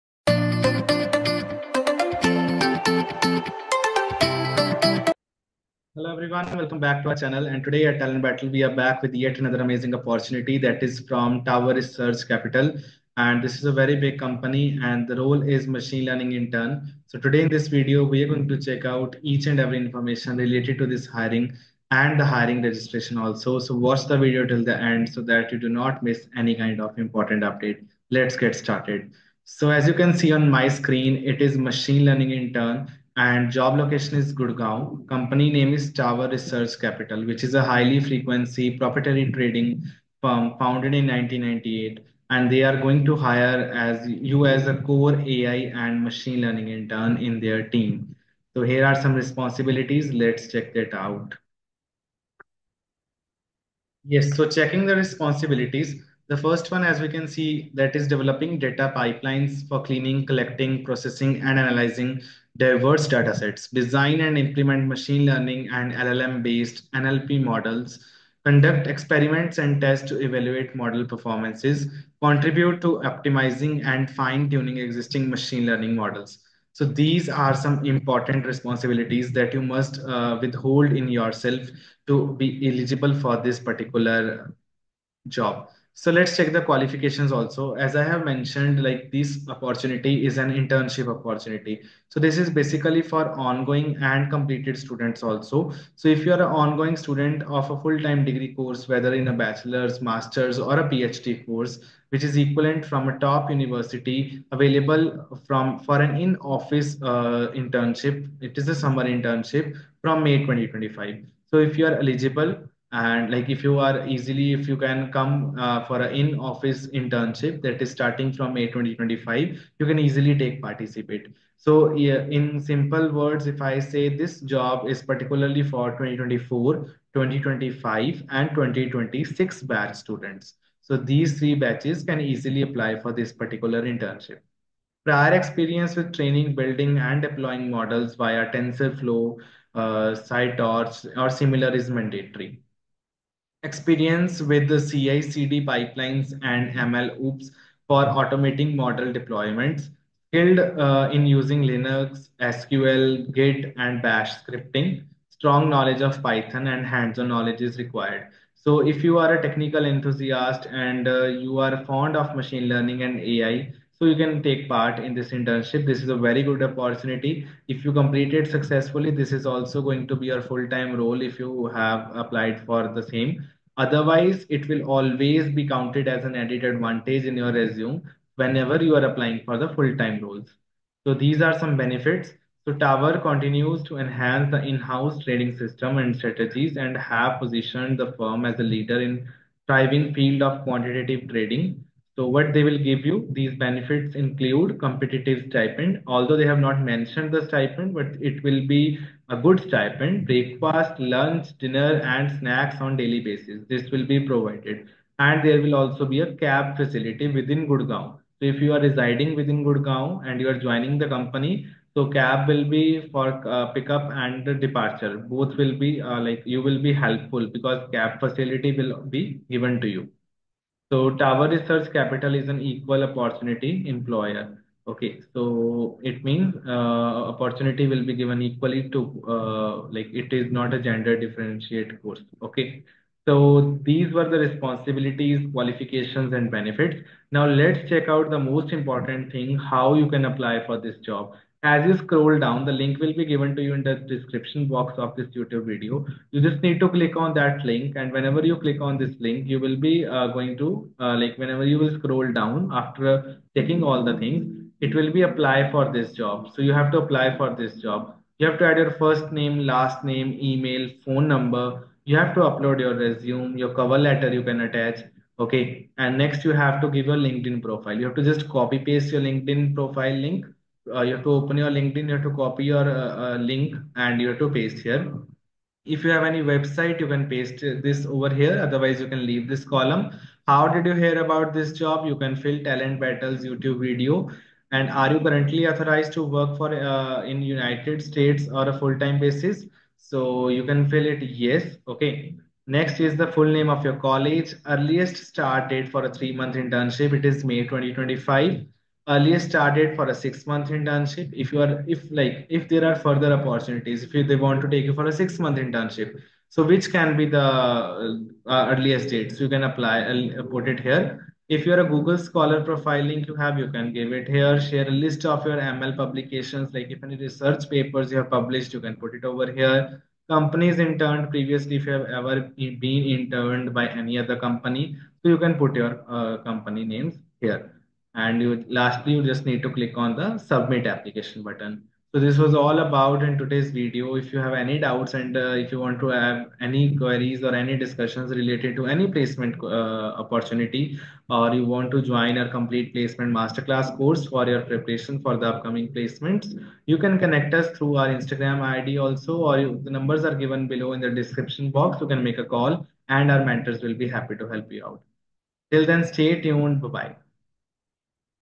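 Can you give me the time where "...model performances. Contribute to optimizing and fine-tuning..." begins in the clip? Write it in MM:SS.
01:10.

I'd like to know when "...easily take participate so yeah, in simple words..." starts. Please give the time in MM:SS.
01:59.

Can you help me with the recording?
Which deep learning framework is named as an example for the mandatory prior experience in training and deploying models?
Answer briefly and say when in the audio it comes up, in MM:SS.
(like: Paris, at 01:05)
TensorFlow, at 02:18.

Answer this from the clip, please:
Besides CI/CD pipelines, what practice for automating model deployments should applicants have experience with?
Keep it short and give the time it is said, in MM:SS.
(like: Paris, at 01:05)
MLOps, at 02:26.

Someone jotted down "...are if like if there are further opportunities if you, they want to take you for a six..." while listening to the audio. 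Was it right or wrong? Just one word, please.
right.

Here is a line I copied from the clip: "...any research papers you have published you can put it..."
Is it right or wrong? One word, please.
right.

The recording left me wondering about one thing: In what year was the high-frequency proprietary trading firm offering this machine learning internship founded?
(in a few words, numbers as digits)
1998.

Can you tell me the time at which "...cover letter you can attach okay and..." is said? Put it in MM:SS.
04:23.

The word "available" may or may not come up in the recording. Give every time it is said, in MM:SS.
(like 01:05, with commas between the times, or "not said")
01:44.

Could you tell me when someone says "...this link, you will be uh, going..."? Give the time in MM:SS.
04:08.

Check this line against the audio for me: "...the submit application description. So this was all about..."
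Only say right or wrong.
wrong.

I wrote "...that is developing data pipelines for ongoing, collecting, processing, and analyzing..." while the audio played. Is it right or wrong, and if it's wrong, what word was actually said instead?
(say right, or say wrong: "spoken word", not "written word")
wrong: "cleaning", not "ongoing".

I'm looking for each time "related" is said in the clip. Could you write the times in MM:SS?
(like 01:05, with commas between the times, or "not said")
00:20, 05:38.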